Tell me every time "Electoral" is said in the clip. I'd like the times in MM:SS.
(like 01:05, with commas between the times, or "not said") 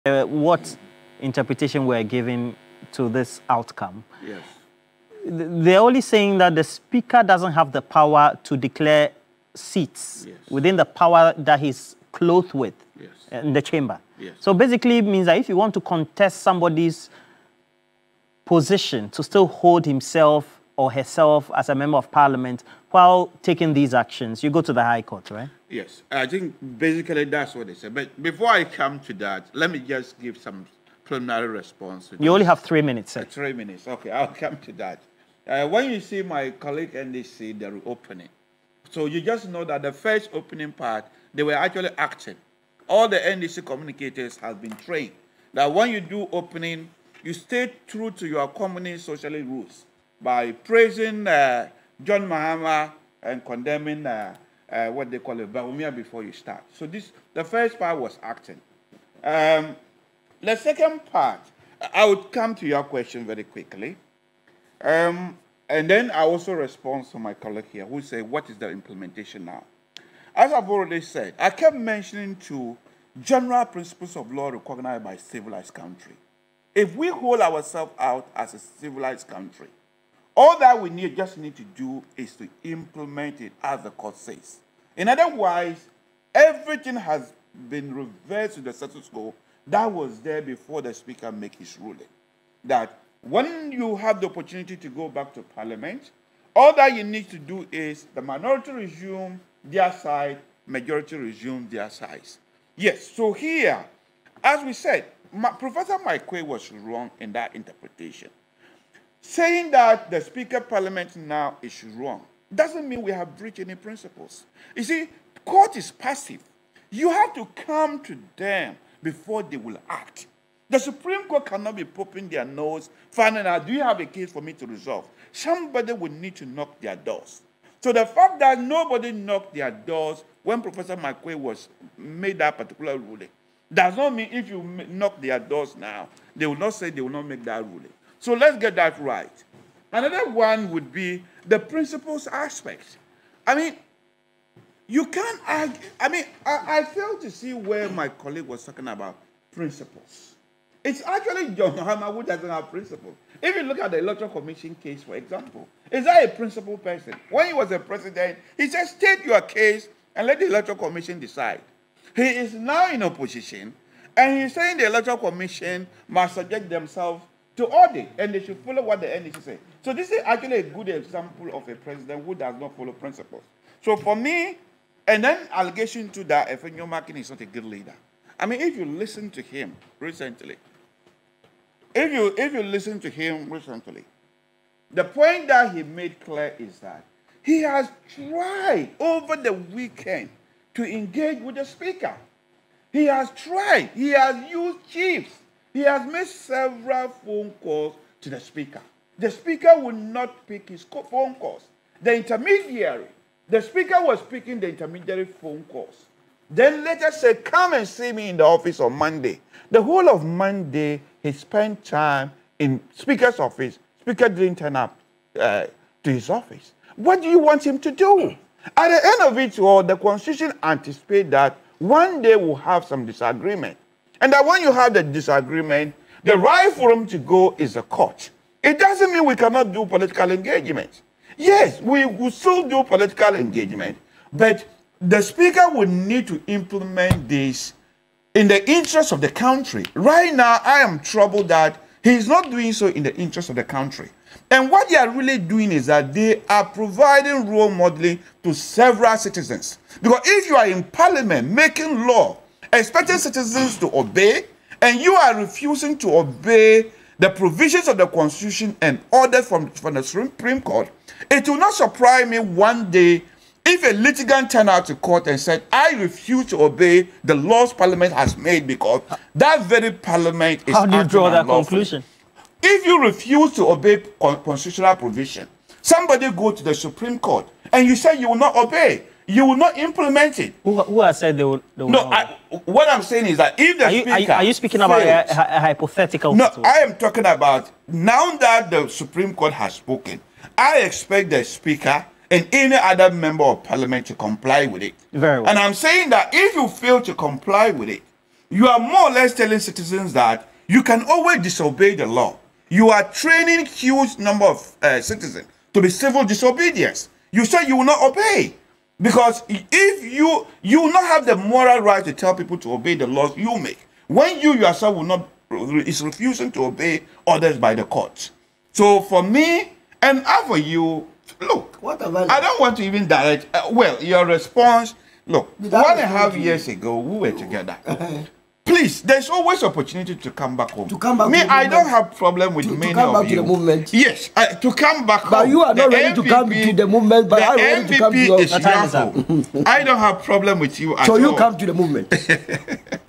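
02:33, 02:40, 02:44.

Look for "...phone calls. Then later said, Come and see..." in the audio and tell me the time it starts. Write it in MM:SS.
03:25.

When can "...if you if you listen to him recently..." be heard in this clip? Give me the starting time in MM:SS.
03:01.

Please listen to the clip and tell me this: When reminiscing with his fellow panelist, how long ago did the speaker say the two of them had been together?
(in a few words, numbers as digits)
1.5 years.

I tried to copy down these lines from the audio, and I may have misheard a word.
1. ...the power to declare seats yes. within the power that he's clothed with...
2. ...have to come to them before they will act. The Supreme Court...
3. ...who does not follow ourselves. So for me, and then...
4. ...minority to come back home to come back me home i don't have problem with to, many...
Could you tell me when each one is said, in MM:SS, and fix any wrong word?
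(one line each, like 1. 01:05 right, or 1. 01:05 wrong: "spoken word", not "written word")
1. 00:07 right
2. 01:57 right
3. 02:52 wrong: "principles", not "ourselves"
4. 05:29 wrong: "opportunity", not "minority".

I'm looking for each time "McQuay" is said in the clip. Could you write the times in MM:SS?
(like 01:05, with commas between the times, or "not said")
02:10.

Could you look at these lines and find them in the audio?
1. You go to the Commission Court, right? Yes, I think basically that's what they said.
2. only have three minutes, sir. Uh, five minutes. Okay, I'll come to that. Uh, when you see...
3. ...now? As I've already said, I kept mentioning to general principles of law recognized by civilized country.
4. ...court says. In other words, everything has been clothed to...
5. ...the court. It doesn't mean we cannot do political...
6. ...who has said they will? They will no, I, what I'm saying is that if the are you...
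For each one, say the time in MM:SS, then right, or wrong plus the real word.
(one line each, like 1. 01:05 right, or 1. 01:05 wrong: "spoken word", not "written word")
1. 00:24 wrong: "High", not "Commission"
2. 00:32 wrong: "three", not "five"
3. 01:09 right
4. 01:23 wrong: "reversed", not "clothed"
5. 03:47 right
6. 04:40 right.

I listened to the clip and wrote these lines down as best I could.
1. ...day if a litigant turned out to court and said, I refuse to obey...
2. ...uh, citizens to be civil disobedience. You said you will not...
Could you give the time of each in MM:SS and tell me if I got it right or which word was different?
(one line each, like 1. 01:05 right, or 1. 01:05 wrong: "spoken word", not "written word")
1. 04:22 right
2. 05:04 right.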